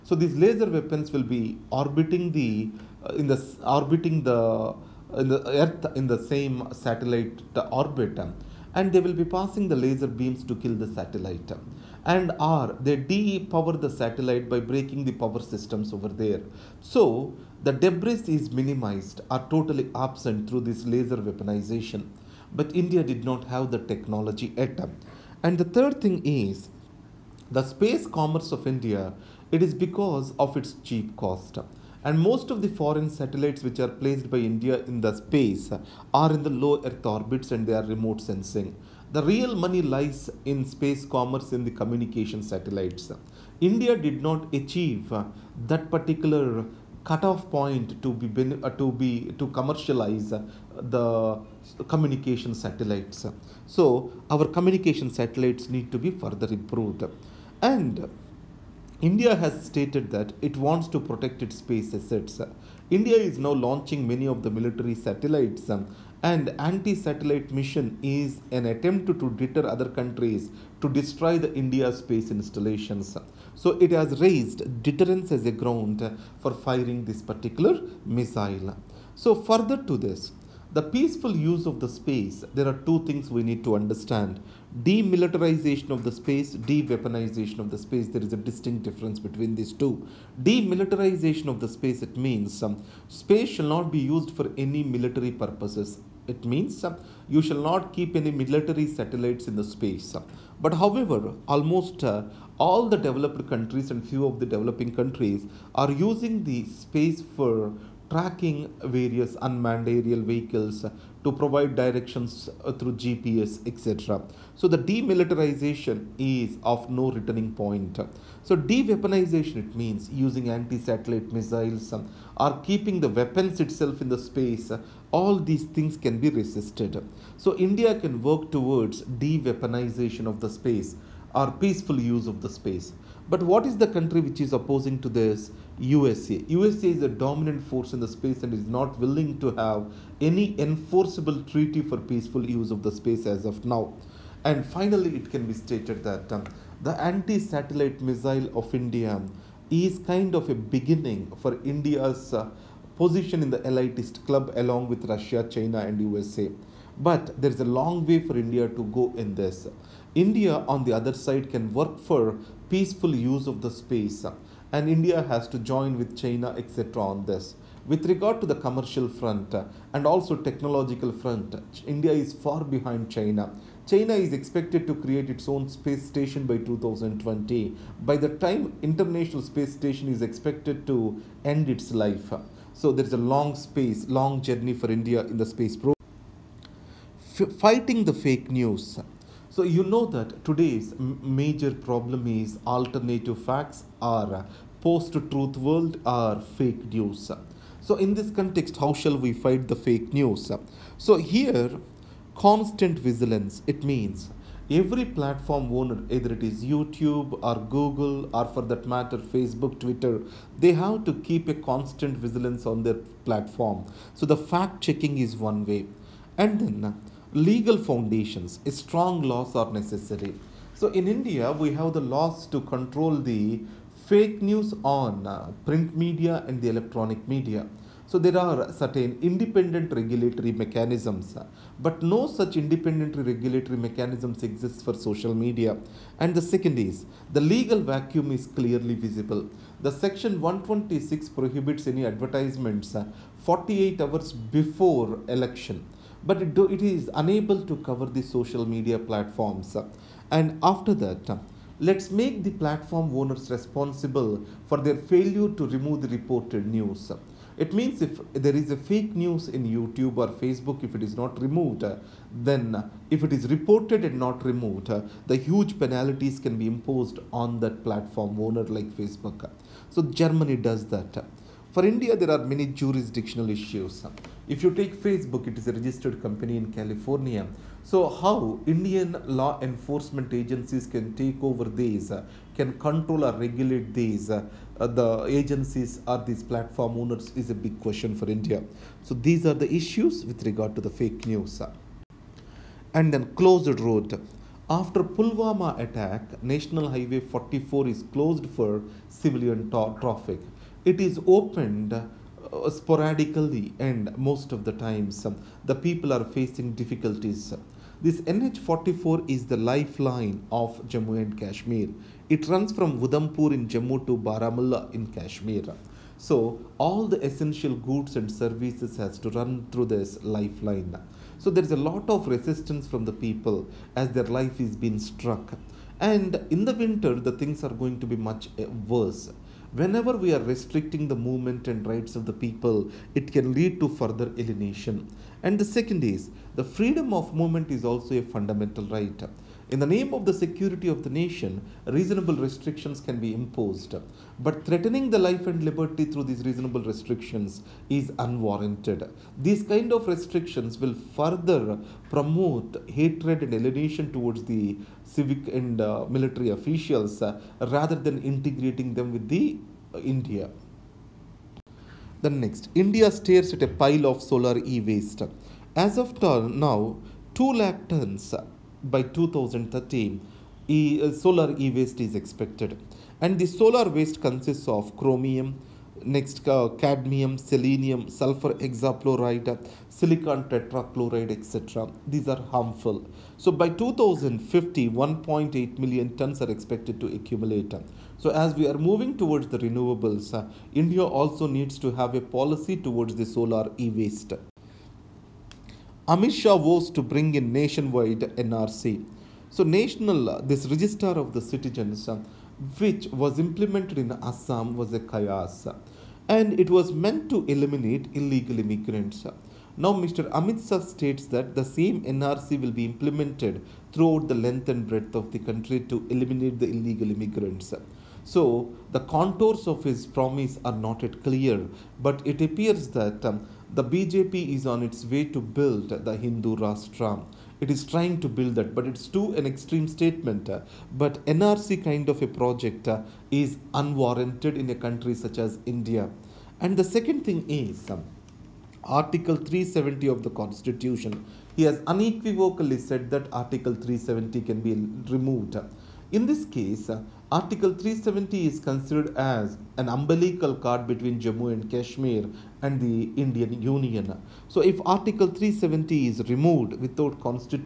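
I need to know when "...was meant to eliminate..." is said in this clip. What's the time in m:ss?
6:46.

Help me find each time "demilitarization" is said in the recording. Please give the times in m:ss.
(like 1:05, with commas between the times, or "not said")
1:24, 1:30, 1:54.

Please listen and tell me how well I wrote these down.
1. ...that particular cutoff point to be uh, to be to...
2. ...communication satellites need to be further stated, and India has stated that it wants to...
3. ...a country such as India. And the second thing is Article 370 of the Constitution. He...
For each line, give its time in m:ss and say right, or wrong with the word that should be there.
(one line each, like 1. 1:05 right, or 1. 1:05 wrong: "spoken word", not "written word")
1. 0:45 right
2. 0:54 wrong: "improved", not "stated"
3. 7:14 right.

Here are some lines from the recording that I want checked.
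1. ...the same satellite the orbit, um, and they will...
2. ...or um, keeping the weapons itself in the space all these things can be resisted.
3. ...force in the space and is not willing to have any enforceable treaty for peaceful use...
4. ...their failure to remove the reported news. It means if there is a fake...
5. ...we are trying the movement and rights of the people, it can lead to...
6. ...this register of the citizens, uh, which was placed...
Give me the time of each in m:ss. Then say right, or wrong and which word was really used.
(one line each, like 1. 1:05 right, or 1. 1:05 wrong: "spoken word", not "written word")
1. 0:06 right
2. 2:01 right
3. 2:17 right
4. 4:14 right
5. 5:30 wrong: "restricting", not "trying"
6. 6:40 wrong: "implemented", not "placed".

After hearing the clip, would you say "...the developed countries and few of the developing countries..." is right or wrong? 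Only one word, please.
right.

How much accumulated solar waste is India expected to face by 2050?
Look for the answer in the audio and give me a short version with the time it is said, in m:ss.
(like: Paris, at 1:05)
1.8 million tons, at 6:24.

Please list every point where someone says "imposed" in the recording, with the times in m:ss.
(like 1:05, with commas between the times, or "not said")
4:26, 5:43.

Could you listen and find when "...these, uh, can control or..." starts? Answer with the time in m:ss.
4:41.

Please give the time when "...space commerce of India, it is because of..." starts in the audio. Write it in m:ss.
0:27.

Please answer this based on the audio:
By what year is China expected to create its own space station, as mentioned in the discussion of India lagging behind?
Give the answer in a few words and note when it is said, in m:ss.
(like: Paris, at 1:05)
2020, at 2:56.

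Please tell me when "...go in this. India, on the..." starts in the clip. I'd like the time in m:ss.
2:38.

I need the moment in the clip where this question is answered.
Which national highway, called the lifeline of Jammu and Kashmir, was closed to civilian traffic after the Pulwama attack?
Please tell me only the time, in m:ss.
4:56.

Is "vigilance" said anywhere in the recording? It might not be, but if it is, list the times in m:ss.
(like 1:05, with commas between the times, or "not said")
3:22, 3:32.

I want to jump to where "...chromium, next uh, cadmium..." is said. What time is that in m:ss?
6:14.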